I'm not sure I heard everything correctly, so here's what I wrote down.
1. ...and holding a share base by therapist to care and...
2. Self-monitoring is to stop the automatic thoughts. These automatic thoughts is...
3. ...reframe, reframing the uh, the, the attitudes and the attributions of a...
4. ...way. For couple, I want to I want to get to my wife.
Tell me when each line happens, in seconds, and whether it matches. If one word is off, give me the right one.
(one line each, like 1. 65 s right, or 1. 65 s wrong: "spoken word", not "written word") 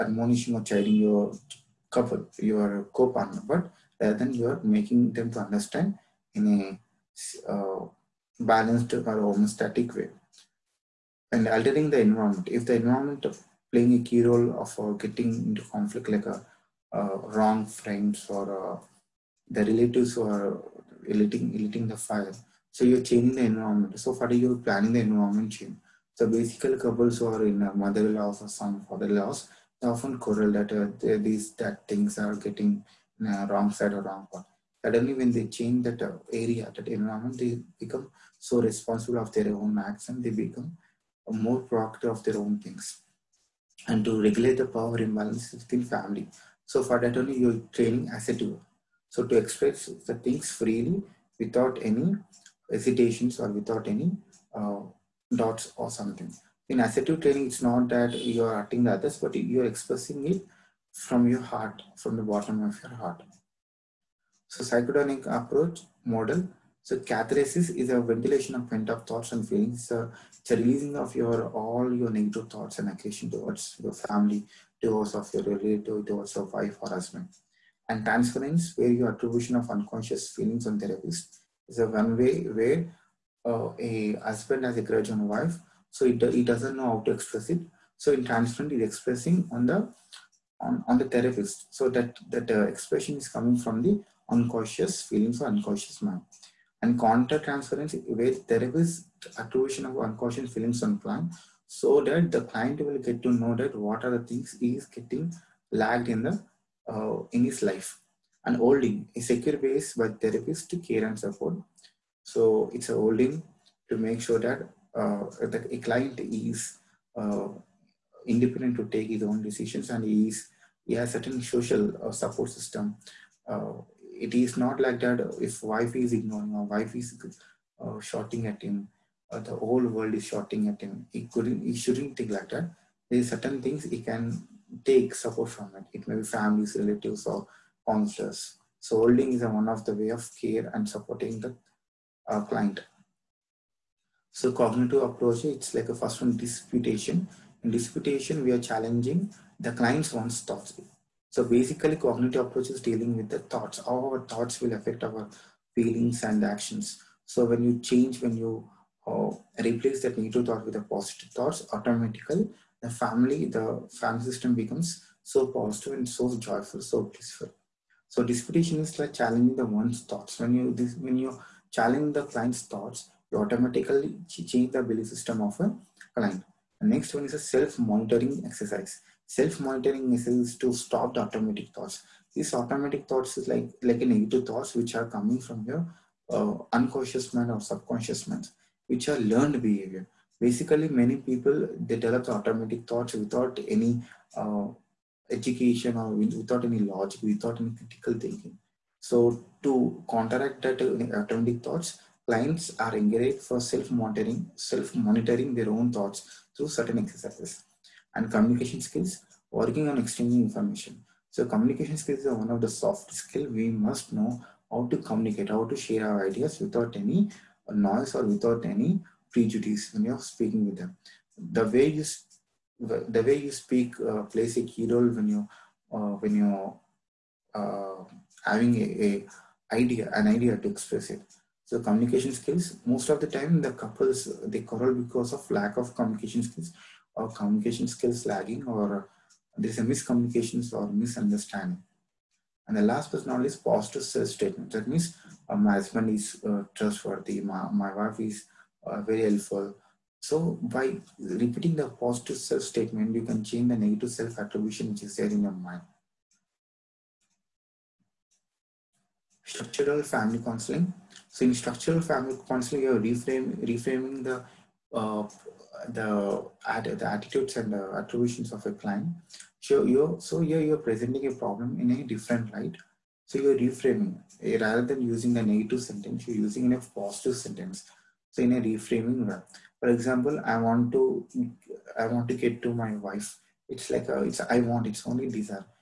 1. 108 s wrong: "secure", not "share"
2. 179 s right
3. 262 s right
4. 279 s wrong: "example", not "couple".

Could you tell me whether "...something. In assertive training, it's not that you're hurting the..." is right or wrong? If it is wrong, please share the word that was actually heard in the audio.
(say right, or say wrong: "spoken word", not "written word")
right.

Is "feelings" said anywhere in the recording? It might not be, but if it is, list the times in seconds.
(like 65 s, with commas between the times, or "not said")
69 s, 80 s, 95 s, 100 s, 155 s.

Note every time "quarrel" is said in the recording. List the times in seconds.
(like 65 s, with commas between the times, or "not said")
30 s, 234 s.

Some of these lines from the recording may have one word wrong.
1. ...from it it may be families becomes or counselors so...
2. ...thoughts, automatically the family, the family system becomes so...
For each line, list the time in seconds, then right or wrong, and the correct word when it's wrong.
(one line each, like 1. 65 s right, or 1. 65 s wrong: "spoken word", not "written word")
1. 135 s wrong: "relatives", not "becomes"
2. 161 s right.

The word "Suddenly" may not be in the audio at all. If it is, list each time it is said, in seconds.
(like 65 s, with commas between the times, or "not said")
34 s.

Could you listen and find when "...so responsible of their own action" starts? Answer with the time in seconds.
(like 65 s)
38 s.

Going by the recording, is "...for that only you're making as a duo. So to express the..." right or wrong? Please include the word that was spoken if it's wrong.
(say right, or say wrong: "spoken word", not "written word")
wrong: "training", not "making".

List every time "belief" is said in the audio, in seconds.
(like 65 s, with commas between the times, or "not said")
174 s.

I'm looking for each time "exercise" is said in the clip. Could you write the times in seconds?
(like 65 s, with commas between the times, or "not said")
178 s, 206 s.